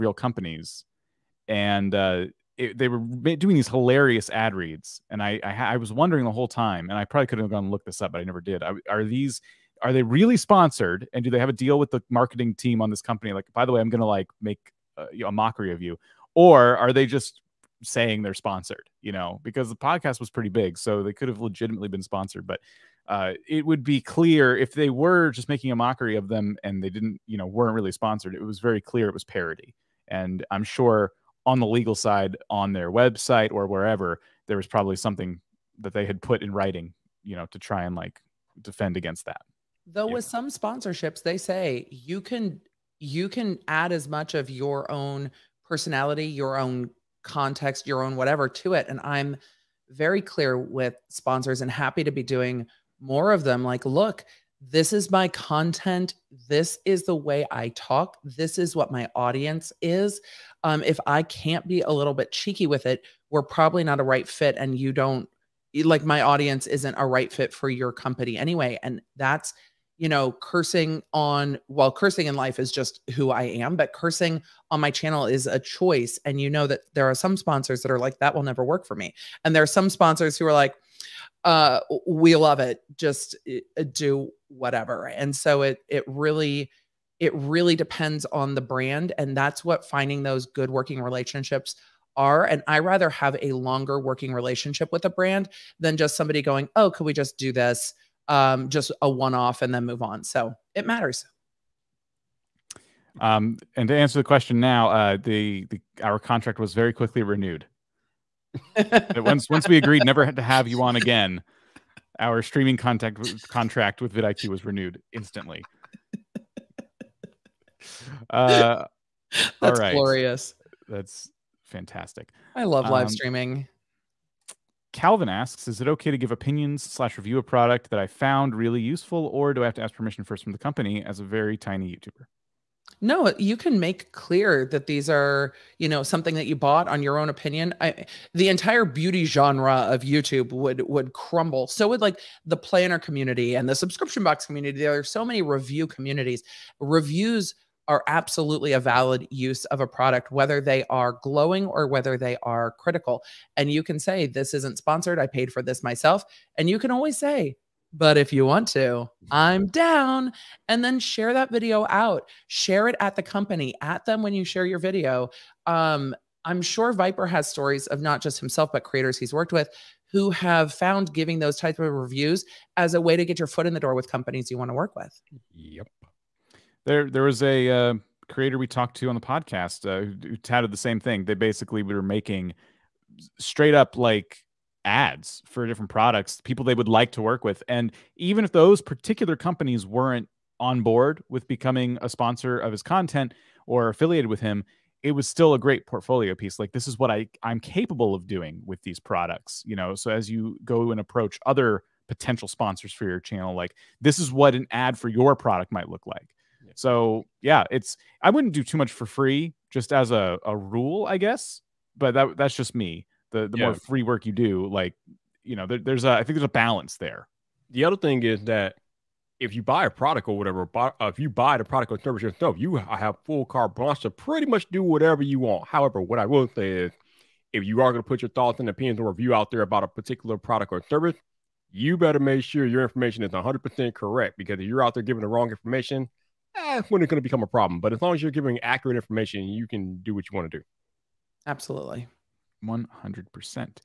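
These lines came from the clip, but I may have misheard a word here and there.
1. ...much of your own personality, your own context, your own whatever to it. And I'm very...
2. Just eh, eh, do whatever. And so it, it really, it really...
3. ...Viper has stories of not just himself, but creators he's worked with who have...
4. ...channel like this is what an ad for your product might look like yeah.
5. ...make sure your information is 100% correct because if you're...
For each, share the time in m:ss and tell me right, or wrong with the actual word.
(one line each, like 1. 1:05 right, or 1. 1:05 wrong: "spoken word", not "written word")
1. 0:44 right
2. 1:22 right
3. 2:46 right
4. 3:23 right
5. 3:52 right.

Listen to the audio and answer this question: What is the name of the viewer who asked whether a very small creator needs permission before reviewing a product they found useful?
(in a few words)
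Calvin.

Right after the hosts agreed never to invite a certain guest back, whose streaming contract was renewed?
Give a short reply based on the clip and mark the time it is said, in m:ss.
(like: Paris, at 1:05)
vidIQ, at 1:54.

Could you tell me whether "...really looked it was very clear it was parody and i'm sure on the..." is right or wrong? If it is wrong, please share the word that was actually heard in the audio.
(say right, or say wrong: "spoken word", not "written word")
wrong: "sponsored", not "looked".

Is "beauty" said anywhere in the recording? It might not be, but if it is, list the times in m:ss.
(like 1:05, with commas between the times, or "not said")
2:18.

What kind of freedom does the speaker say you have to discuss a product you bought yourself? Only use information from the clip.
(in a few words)
carte blanche.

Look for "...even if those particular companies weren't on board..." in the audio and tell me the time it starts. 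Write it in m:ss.
3:08.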